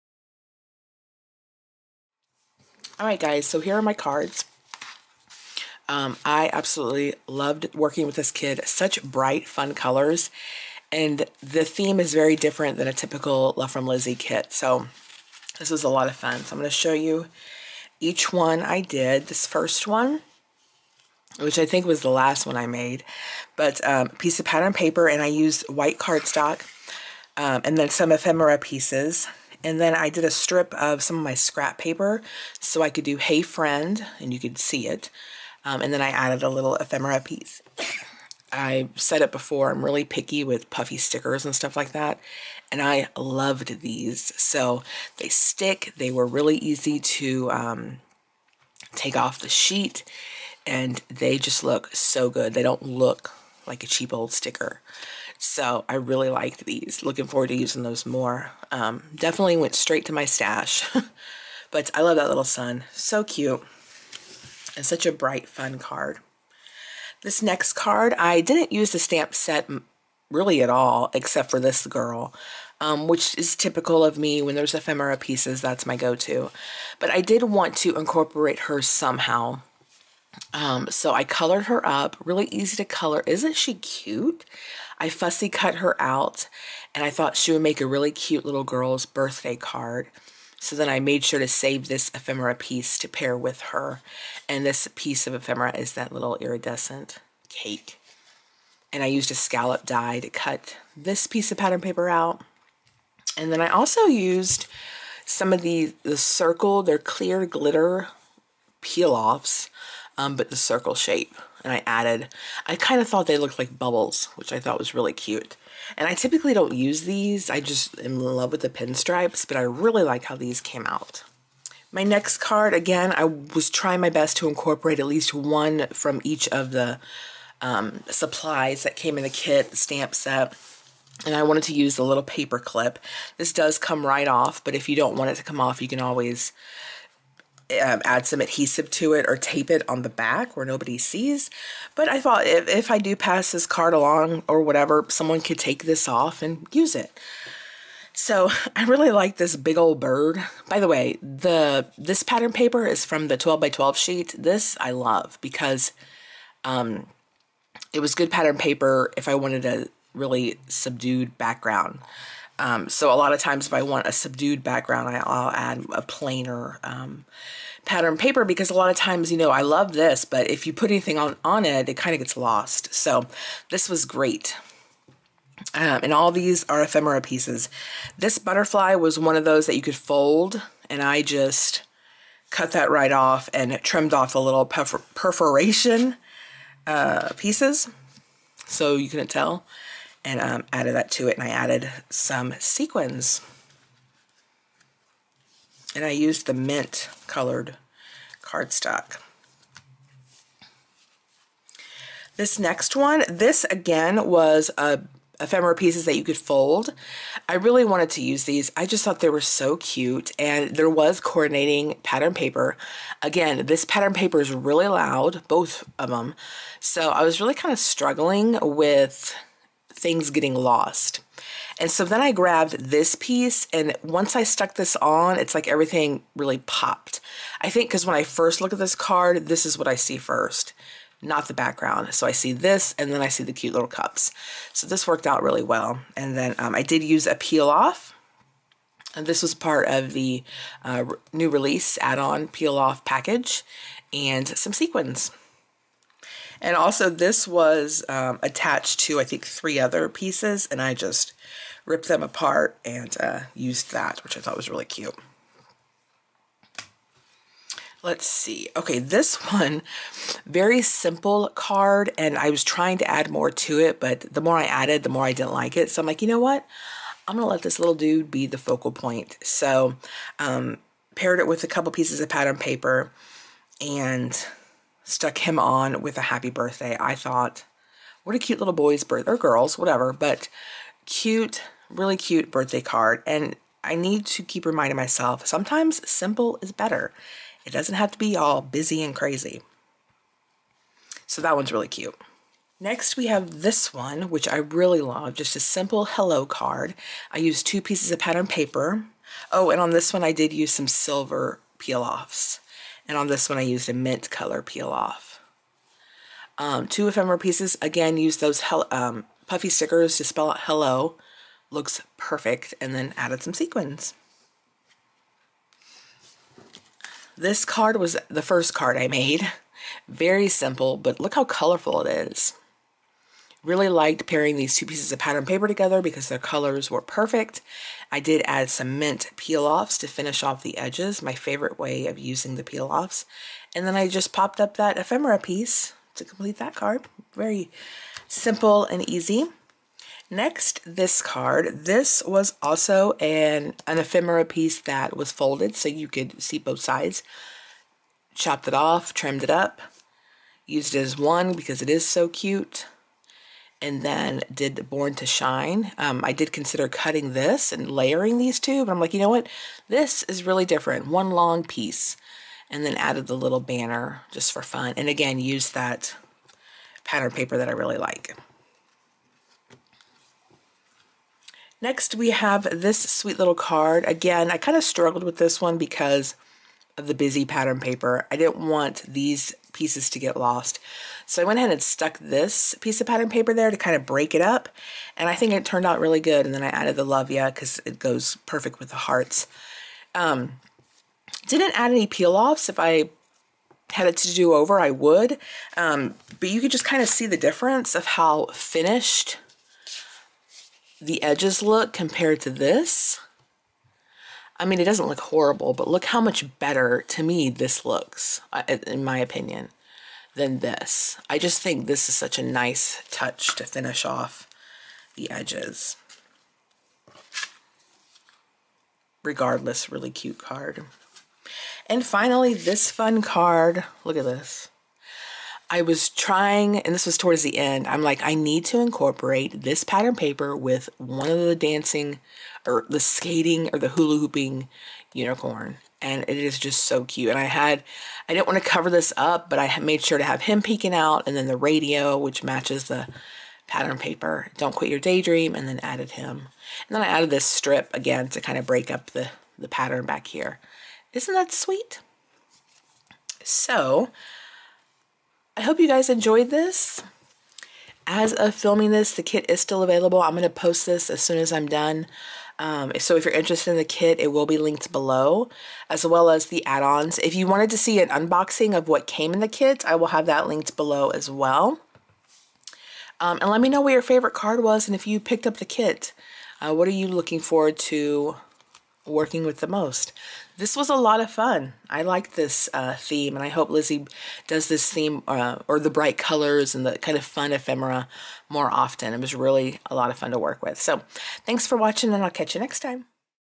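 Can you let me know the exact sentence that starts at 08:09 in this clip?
It was really a lot of fun to work with.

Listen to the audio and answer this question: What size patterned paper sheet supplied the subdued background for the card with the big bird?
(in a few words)
12 by 12.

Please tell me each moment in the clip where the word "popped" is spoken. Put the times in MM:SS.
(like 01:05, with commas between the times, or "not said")
03:46, 05:34.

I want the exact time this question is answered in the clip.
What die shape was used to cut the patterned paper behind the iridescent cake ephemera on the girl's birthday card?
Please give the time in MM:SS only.
01:39.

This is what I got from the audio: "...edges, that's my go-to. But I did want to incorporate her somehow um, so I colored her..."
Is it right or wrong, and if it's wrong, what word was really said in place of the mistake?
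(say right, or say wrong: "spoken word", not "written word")
wrong: "pieces", not "edges".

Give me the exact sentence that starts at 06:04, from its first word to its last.
And again, used that pattern paper that I really like.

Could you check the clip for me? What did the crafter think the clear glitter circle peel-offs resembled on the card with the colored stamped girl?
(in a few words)
Bubbles.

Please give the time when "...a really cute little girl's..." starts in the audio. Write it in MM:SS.
01:27.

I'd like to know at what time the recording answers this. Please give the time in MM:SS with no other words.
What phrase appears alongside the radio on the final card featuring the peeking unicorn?
07:24.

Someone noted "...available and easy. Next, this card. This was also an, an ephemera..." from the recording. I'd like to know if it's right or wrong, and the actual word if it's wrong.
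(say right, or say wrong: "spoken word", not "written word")
wrong: "simple", not "available".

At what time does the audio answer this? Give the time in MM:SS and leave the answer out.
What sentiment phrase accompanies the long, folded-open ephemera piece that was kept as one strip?
05:54.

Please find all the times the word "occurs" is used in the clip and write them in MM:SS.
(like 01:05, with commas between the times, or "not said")
not said.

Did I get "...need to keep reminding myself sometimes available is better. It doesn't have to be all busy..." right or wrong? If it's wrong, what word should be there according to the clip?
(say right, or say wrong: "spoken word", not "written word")
wrong: "simple", not "available".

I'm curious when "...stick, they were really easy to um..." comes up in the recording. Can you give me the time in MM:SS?
00:45.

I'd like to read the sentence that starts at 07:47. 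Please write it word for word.
If you wanted to see an unboxing of what came in the kit, I will have that linked below as well.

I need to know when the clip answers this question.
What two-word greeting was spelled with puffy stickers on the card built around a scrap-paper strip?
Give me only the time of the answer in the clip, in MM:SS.
00:33.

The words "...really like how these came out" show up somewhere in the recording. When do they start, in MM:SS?
01:59.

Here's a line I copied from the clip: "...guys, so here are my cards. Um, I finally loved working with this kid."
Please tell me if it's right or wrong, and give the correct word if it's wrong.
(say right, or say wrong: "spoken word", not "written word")
wrong: "absolutely", not "finally".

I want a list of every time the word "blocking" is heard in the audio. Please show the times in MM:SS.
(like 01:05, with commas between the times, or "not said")
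not said.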